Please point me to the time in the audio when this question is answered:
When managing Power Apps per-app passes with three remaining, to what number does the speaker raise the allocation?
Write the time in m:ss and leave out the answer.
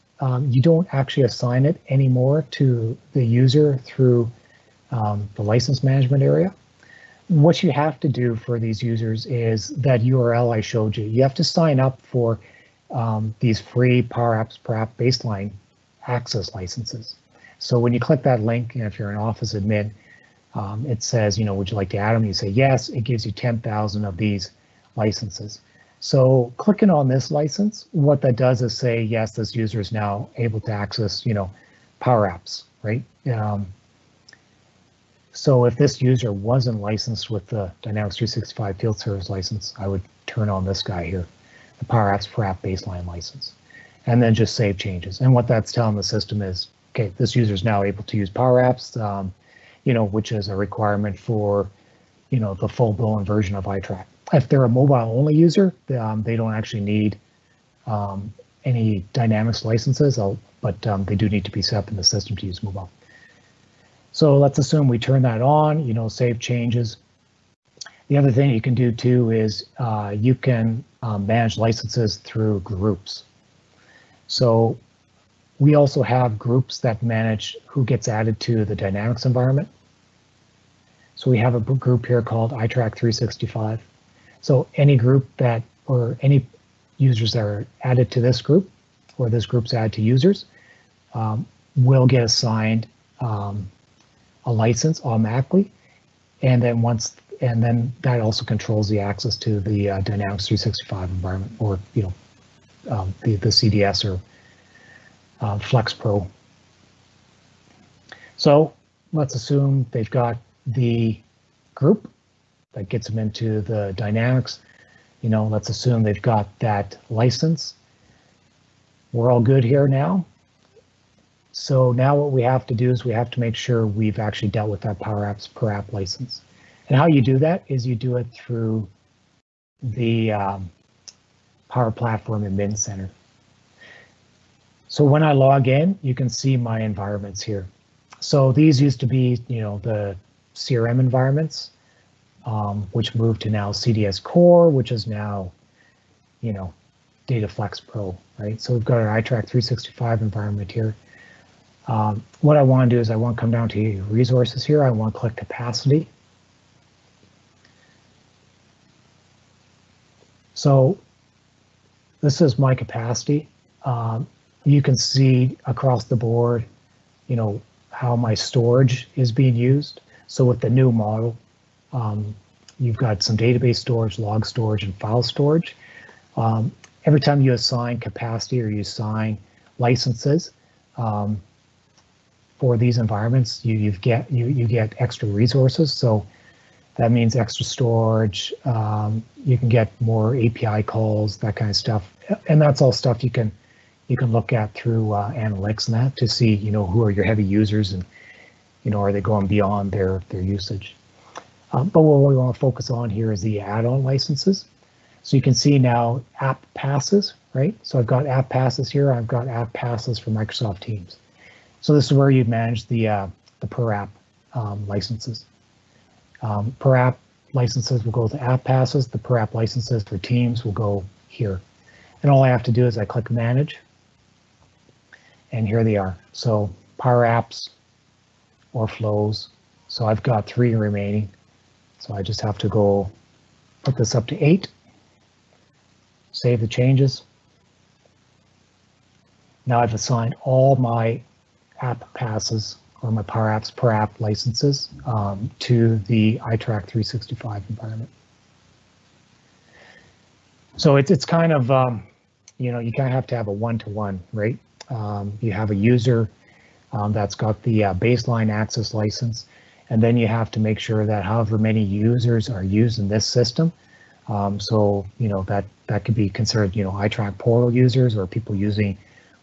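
3:54.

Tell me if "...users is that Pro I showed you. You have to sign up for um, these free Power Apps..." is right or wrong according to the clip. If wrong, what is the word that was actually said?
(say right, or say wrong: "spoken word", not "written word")
wrong: "URL", not "Pro".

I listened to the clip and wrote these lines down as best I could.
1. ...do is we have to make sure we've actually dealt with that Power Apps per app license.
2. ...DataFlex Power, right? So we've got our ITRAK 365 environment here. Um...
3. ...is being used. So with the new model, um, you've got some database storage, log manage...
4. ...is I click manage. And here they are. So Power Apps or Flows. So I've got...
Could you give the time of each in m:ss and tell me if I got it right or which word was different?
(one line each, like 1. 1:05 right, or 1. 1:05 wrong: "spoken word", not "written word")
1. 2:02 right
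2. 2:27 wrong: "Pro", not "Power"
3. 2:49 wrong: "storage", not "manage"
4. 3:42 right.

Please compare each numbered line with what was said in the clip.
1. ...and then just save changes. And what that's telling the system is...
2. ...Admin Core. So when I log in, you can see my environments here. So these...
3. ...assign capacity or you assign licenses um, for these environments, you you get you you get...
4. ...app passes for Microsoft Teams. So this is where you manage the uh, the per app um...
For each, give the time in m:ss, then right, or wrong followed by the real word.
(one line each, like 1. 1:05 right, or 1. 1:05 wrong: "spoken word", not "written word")
1. 0:44 right
2. 2:12 wrong: "Center", not "Core"
3. 2:57 right
4. 3:29 right.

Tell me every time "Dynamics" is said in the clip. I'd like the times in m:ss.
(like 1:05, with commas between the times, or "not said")
0:37, 0:59, 1:18, 1:40, 1:53.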